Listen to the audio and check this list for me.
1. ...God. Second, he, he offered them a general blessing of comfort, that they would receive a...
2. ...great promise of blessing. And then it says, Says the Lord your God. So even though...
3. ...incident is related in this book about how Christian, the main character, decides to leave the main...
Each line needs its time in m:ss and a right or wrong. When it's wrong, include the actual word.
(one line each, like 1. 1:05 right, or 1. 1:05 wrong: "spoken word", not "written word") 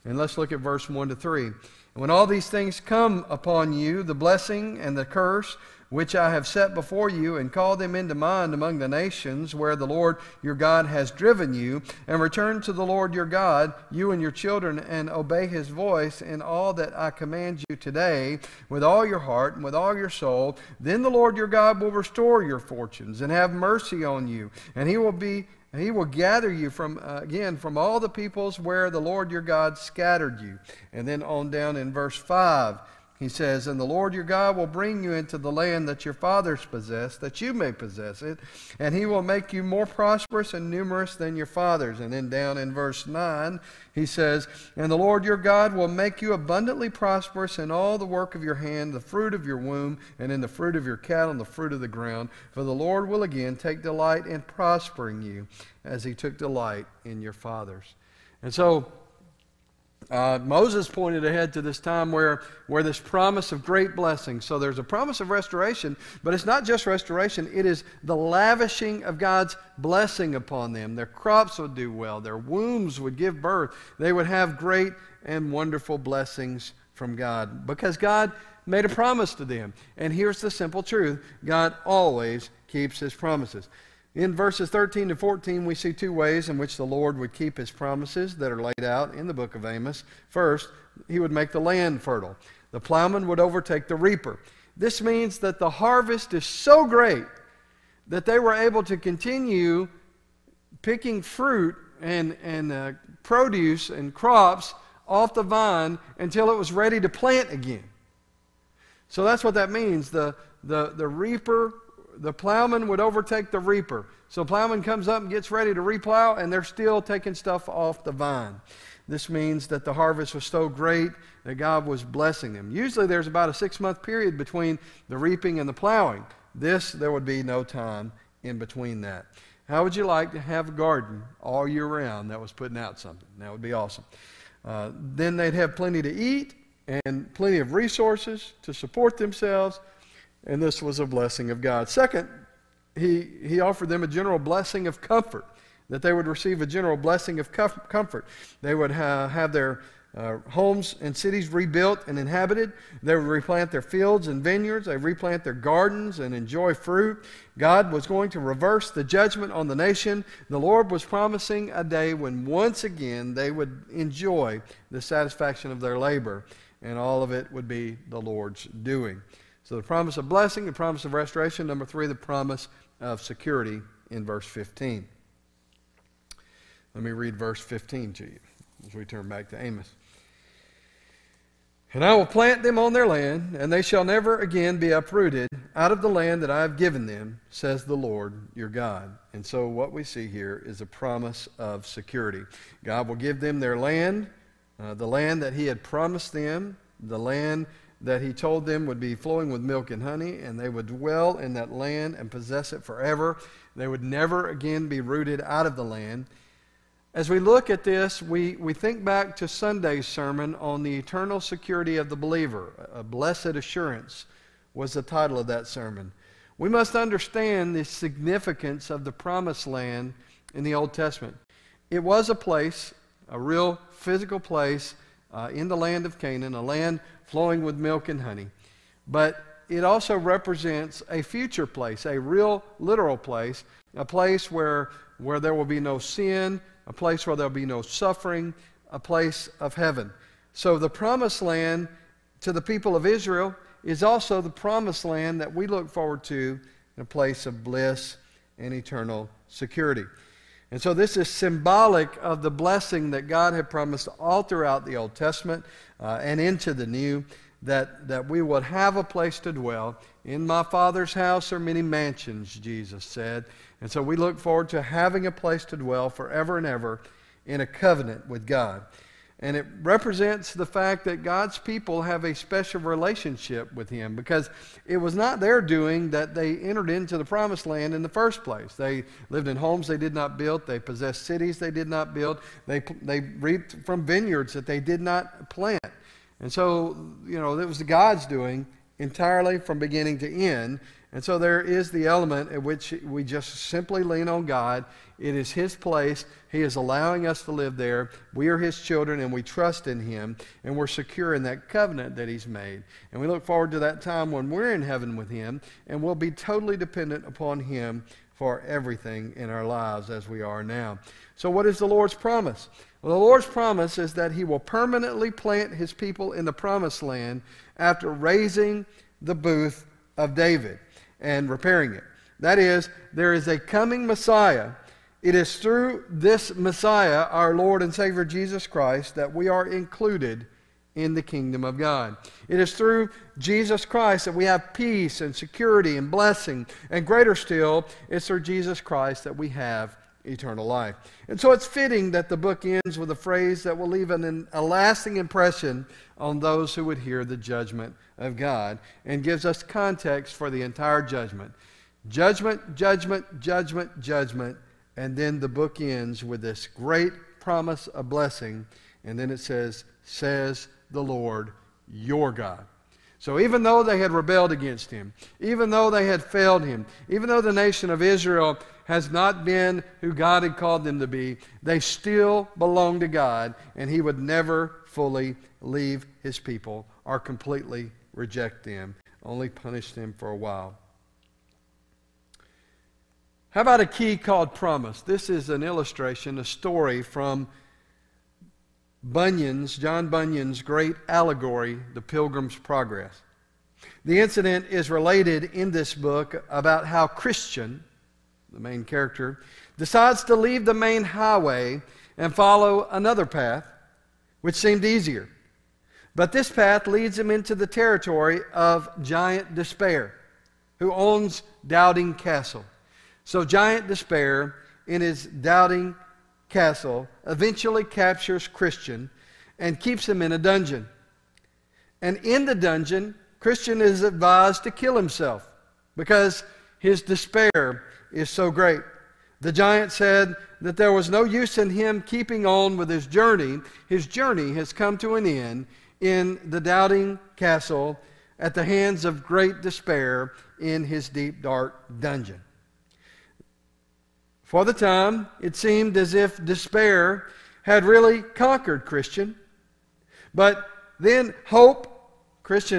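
1. 2:21 right
2. 5:56 right
3. 6:34 right.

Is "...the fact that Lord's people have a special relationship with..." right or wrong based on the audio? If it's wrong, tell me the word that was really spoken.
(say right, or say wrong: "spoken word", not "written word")
wrong: "God", not "Lord".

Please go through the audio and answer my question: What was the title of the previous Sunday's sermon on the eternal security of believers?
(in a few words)
A Blessed Assurance.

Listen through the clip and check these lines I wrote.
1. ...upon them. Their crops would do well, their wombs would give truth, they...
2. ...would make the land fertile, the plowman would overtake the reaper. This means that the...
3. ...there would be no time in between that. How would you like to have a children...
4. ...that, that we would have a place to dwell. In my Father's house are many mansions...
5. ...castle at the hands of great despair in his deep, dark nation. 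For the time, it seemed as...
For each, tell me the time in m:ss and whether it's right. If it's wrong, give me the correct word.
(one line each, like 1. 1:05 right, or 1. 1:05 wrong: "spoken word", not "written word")
1. 1:10 wrong: "birth", not "truth"
2. 1:31 right
3. 2:06 wrong: "garden", not "children"
4. 4:17 right
5. 7:17 wrong: "dungeon", not "nation".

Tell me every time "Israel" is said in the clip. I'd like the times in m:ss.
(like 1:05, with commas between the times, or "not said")
4:03, 6:08.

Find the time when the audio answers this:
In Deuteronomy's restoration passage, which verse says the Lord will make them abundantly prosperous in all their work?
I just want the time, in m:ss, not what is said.
0:42.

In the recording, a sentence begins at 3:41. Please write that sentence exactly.
It was a place, a real physical place uh, in the land of Canaan, a land flowing with milk and honey.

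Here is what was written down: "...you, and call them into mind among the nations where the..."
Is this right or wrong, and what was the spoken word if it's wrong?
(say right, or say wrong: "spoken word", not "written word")
right.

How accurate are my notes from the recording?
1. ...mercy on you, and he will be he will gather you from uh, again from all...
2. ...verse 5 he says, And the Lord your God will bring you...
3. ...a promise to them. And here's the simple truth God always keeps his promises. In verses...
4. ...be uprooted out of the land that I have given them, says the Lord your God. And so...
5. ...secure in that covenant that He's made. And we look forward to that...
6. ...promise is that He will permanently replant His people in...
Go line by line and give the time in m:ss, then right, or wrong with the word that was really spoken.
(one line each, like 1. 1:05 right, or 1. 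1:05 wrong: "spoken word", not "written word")
1. 0:23 right
2. 0:31 right
3. 1:18 right
4. 3:04 right
5. 5:00 right
6. 5:13 wrong: "plant", not "replant".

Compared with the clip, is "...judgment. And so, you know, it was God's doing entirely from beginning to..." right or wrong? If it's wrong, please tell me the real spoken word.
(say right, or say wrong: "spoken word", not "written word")
wrong: "plant", not "judgment".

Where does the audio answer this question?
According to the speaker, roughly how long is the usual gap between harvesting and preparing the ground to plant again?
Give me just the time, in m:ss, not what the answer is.
2:03.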